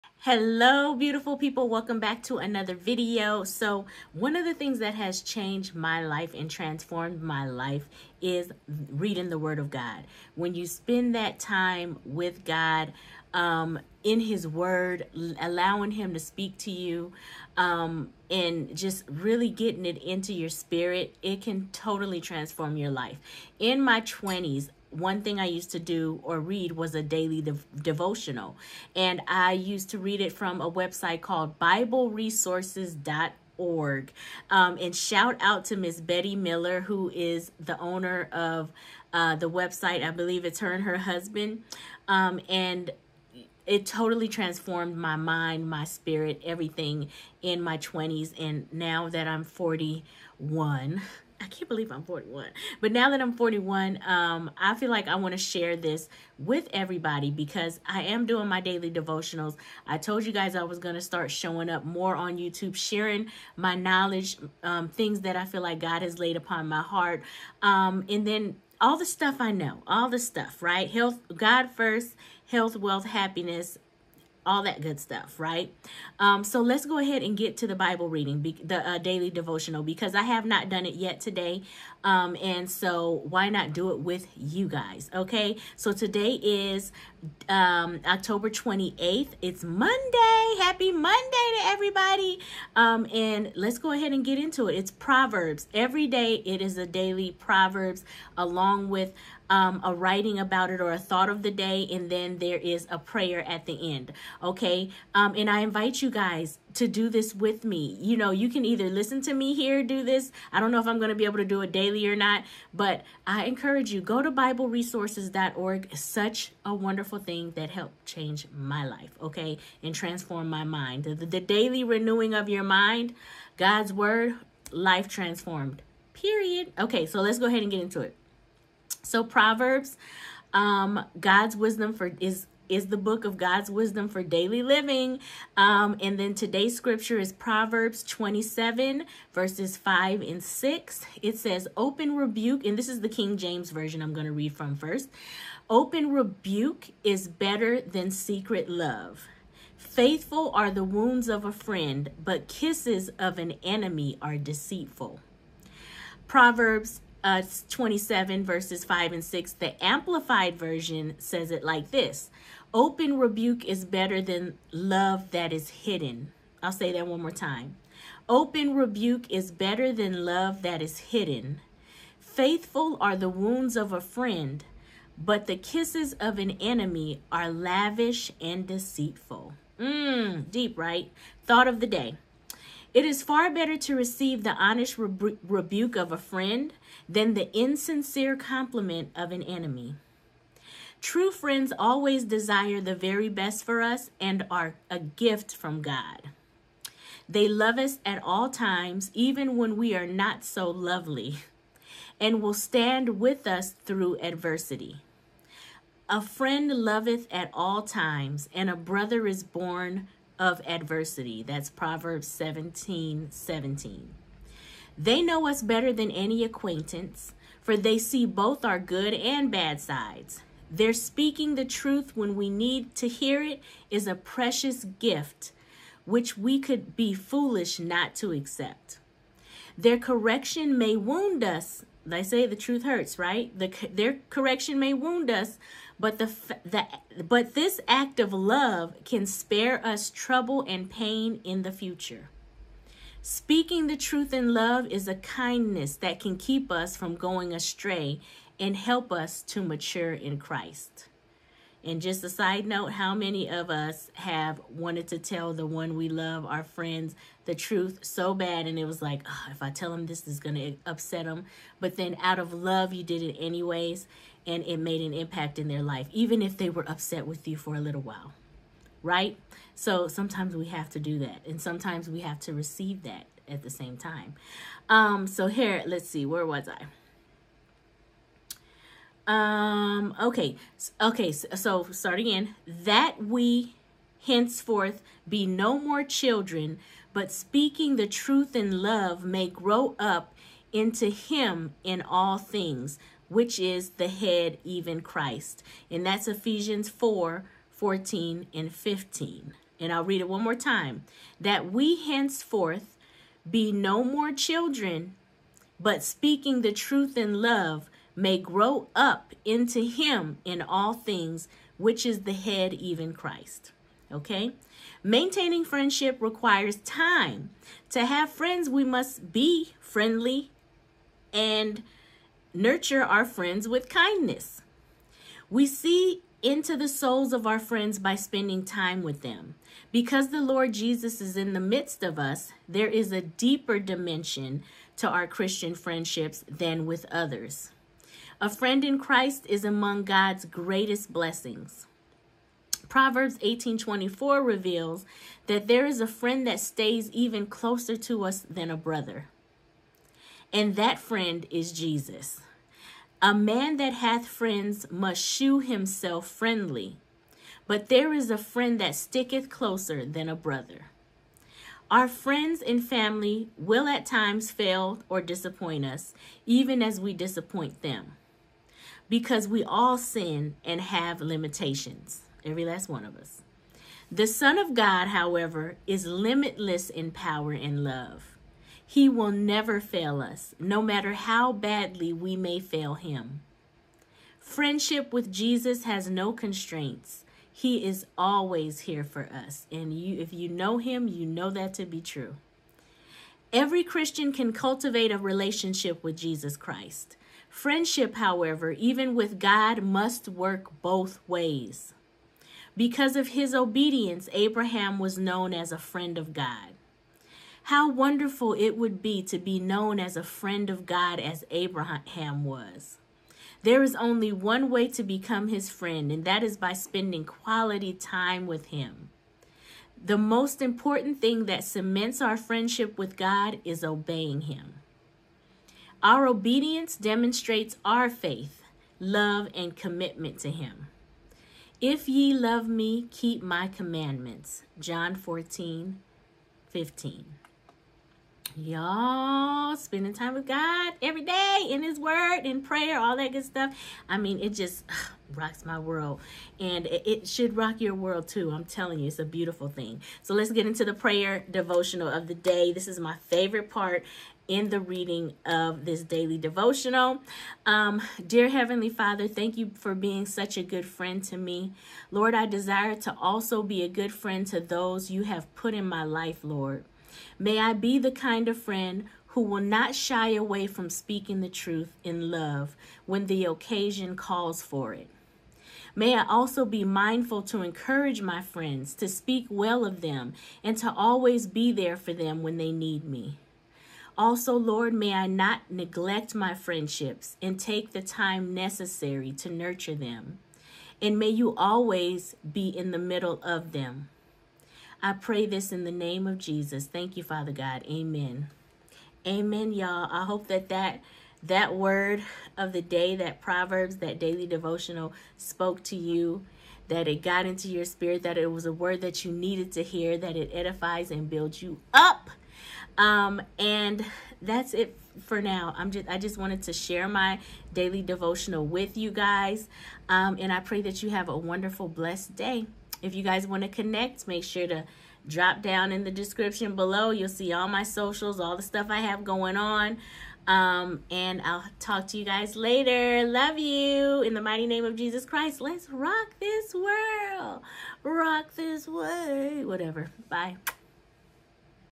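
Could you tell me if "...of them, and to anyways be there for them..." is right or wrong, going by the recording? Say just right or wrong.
wrong.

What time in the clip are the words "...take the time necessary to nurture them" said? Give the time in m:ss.
8:07.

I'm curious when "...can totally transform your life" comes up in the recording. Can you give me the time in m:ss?
0:21.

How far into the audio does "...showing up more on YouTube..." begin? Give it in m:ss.
1:01.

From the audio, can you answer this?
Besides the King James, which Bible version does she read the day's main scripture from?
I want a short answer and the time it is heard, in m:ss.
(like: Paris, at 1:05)
Amplified Version, at 2:39.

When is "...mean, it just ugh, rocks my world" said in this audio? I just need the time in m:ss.
7:24.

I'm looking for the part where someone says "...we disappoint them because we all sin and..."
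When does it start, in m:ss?
6:06.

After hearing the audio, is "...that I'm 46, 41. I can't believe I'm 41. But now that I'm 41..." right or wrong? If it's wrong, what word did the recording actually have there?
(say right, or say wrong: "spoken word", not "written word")
wrong: "40", not "46".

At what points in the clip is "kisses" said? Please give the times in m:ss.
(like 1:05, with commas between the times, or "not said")
2:32, 2:55.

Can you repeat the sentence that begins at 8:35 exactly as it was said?
I'm just I just wanted to share my daily devotional with you guys.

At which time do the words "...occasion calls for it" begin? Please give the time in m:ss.
7:53.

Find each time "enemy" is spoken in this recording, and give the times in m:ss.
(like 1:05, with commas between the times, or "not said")
2:33, 2:56, 3:09.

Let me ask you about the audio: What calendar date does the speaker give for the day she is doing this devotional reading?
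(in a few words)
October 28th.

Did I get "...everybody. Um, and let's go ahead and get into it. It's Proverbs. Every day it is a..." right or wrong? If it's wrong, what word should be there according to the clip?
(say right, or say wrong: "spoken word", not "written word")
right.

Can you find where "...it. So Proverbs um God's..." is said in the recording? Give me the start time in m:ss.
2:08.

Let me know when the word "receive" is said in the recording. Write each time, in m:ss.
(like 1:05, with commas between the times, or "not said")
3:03, 4:32.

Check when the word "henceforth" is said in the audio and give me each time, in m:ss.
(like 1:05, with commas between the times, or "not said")
4:44, 5:02.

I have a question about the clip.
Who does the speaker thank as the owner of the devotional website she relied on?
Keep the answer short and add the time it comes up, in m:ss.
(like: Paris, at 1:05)
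Betty Miller, at 0:35.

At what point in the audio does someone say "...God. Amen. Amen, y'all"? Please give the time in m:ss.
8:17.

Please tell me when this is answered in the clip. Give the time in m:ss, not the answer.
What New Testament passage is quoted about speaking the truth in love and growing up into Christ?
4:56.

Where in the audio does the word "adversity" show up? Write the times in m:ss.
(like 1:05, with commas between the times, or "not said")
3:24, 3:30.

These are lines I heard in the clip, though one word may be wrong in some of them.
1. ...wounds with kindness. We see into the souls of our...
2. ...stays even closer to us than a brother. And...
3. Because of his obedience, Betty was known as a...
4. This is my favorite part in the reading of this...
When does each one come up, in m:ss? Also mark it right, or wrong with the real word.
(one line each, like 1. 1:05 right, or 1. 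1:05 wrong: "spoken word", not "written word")
1. 5:23 wrong: "friends", not "wounds"
2. 5:46 right
3. 6:42 wrong: "Abraham", not "Betty"
4. 7:32 right.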